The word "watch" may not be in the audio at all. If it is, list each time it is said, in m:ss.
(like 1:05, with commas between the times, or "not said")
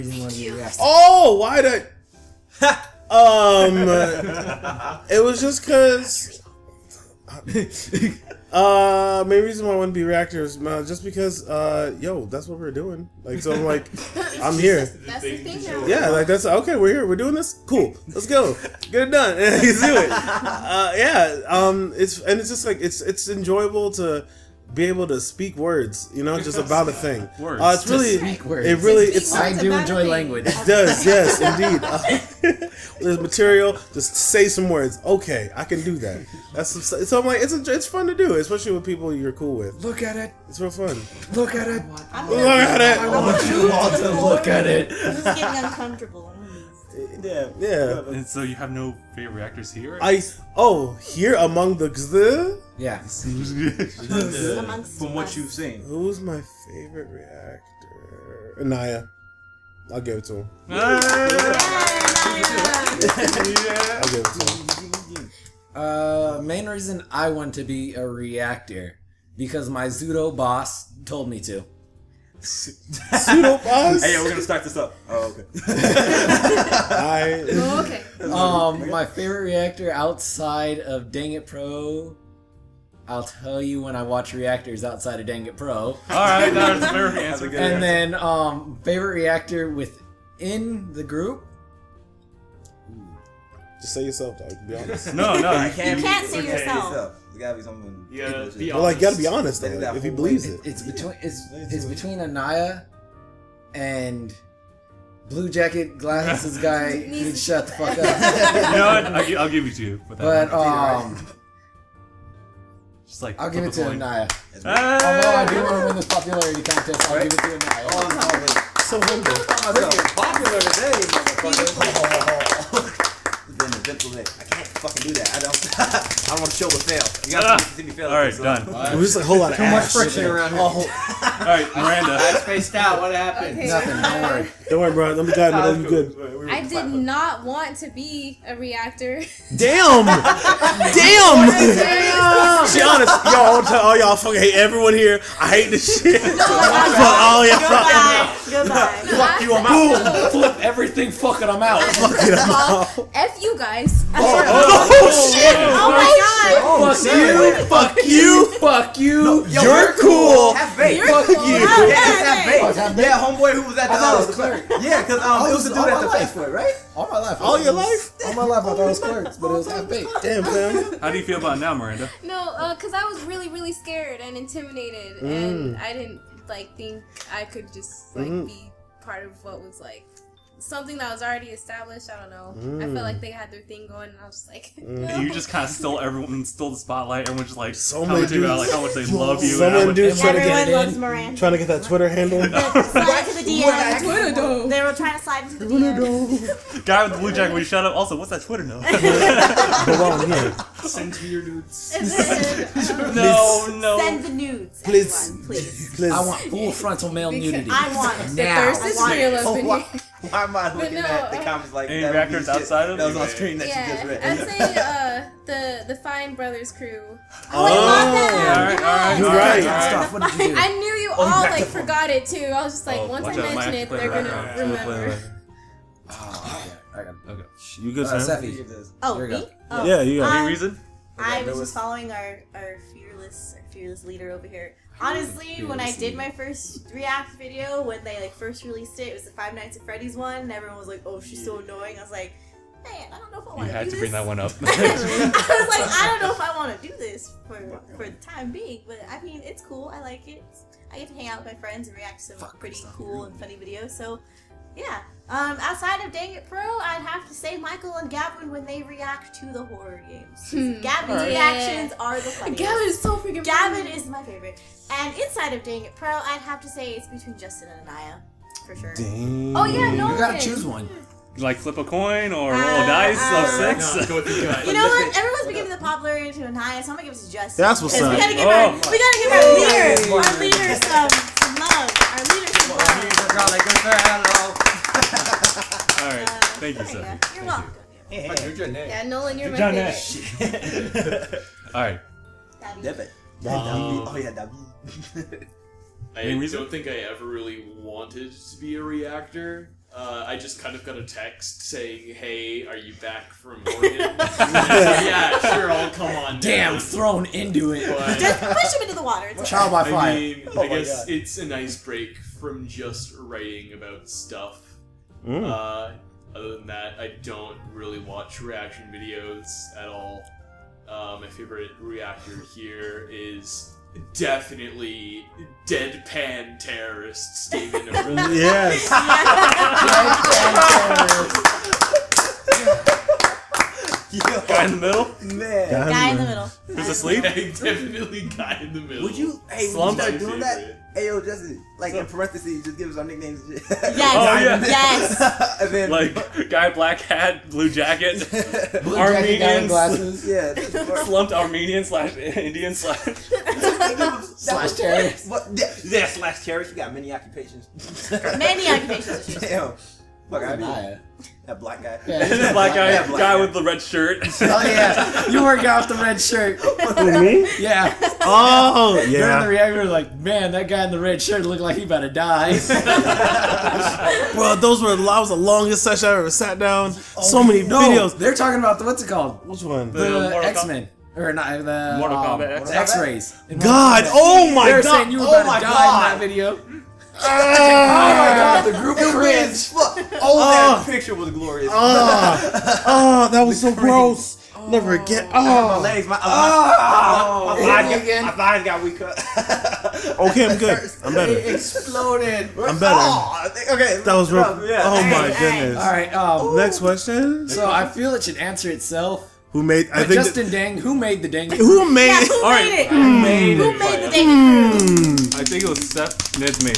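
1:24, 5:17.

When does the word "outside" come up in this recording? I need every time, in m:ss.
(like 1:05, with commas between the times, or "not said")
1:19, 1:24, 3:32, 4:15.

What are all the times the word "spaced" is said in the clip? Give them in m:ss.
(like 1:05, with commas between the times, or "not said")
2:12.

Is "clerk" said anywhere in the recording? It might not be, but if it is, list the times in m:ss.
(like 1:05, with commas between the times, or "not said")
2:44, 2:48.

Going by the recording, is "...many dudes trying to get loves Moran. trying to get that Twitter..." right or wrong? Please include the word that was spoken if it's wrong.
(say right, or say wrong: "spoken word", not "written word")
right.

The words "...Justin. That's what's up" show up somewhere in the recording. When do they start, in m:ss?
4:37.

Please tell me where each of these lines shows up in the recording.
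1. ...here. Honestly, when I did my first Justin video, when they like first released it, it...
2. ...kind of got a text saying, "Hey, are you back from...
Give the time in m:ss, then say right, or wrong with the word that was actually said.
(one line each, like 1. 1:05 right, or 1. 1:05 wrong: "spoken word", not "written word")
1. 3:54 wrong: "React", not "Justin"
2. 5:00 right.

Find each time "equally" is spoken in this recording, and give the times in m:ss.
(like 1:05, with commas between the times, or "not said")
not said.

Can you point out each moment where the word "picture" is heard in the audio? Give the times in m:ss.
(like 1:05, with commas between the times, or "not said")
6:30.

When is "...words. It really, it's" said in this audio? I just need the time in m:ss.
0:28.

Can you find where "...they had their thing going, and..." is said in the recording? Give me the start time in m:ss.
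3:03.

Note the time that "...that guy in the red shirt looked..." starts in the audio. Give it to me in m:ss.
6:10.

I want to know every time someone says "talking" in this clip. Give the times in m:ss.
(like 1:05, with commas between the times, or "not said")
6:18.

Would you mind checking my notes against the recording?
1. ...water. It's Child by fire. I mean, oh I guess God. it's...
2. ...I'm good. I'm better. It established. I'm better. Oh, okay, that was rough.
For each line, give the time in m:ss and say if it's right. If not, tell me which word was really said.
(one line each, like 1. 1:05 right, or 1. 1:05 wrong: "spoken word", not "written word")
1. 5:09 right
2. 6:40 wrong: "exploded", not "established".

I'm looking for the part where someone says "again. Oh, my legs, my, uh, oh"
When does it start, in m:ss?
6:35.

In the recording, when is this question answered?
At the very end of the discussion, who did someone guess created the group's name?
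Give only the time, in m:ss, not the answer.
6:55.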